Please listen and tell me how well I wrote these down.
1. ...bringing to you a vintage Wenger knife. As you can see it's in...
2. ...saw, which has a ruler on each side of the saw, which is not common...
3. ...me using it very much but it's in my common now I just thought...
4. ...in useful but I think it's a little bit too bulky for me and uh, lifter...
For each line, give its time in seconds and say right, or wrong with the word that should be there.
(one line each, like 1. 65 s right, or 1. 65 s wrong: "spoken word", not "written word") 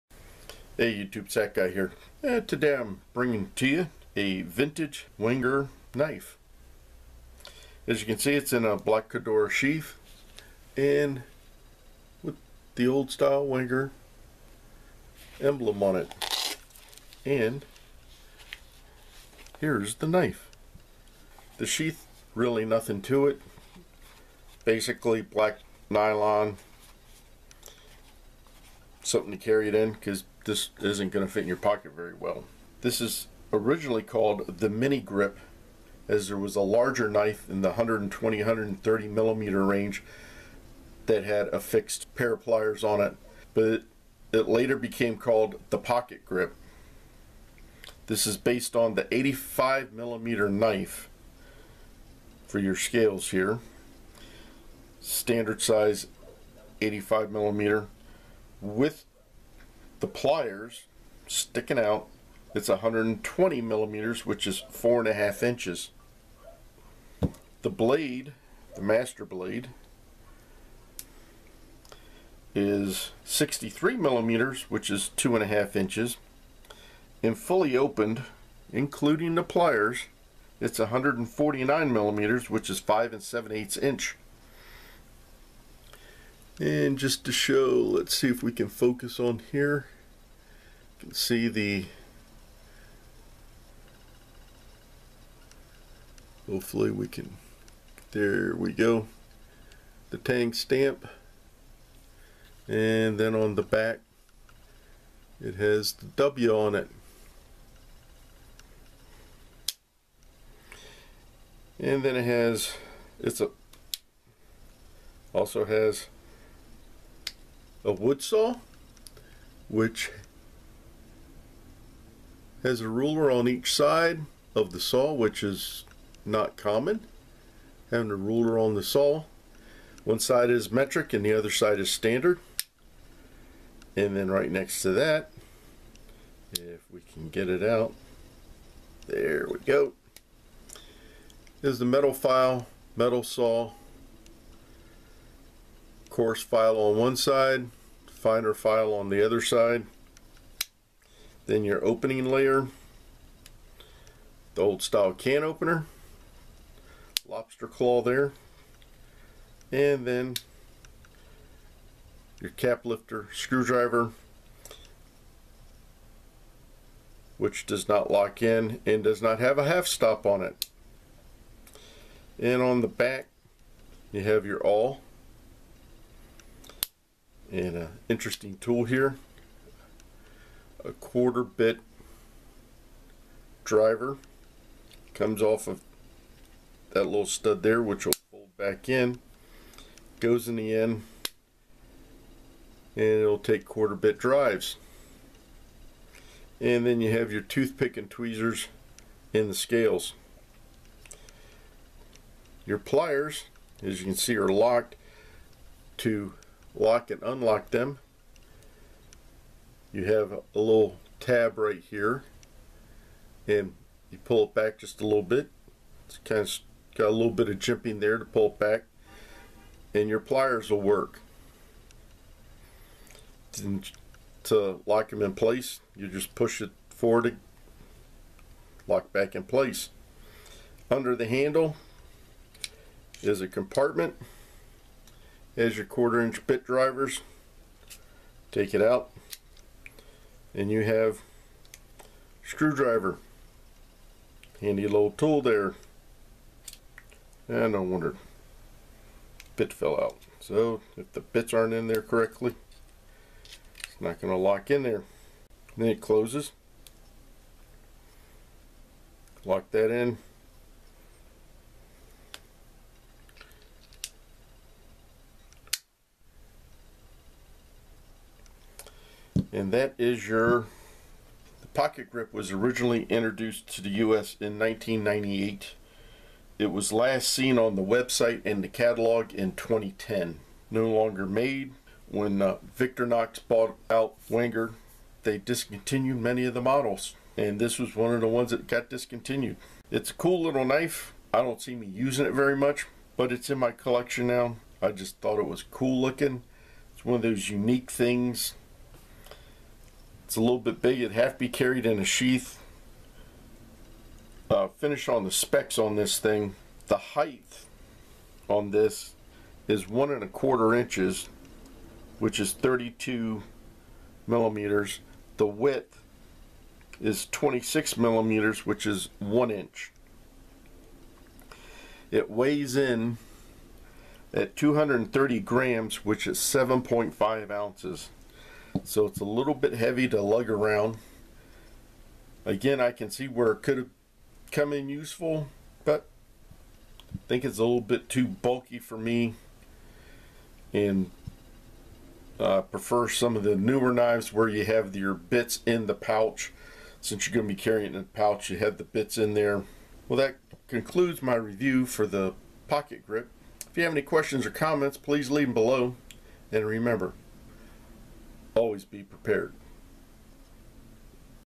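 1. 3 s right
2. 118 s right
3. 291 s wrong: "collection", not "common"
4. 334 s wrong: "prefer", not "lifter".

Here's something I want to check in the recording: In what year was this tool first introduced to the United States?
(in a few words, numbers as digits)
1998.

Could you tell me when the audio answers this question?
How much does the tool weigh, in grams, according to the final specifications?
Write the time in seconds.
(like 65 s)
324 s.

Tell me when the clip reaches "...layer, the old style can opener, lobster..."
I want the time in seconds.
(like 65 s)
152 s.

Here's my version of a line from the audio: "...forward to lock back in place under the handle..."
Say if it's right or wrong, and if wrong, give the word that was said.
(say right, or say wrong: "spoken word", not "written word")
right.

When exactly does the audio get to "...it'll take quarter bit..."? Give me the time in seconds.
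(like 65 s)
193 s.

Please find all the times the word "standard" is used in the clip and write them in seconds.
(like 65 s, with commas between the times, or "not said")
55 s, 131 s.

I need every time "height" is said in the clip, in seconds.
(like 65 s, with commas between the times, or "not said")
306 s.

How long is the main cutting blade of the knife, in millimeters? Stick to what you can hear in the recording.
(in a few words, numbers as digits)
63 millimeters.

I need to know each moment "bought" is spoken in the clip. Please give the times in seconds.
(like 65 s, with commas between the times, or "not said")
283 s.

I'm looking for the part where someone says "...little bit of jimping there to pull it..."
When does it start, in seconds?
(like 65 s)
217 s.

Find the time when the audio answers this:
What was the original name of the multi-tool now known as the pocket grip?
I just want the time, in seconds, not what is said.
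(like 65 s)
34 s.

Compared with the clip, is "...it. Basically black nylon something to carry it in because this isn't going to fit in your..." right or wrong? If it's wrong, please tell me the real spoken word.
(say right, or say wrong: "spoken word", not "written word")
right.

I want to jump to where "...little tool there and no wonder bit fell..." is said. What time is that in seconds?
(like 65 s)
244 s.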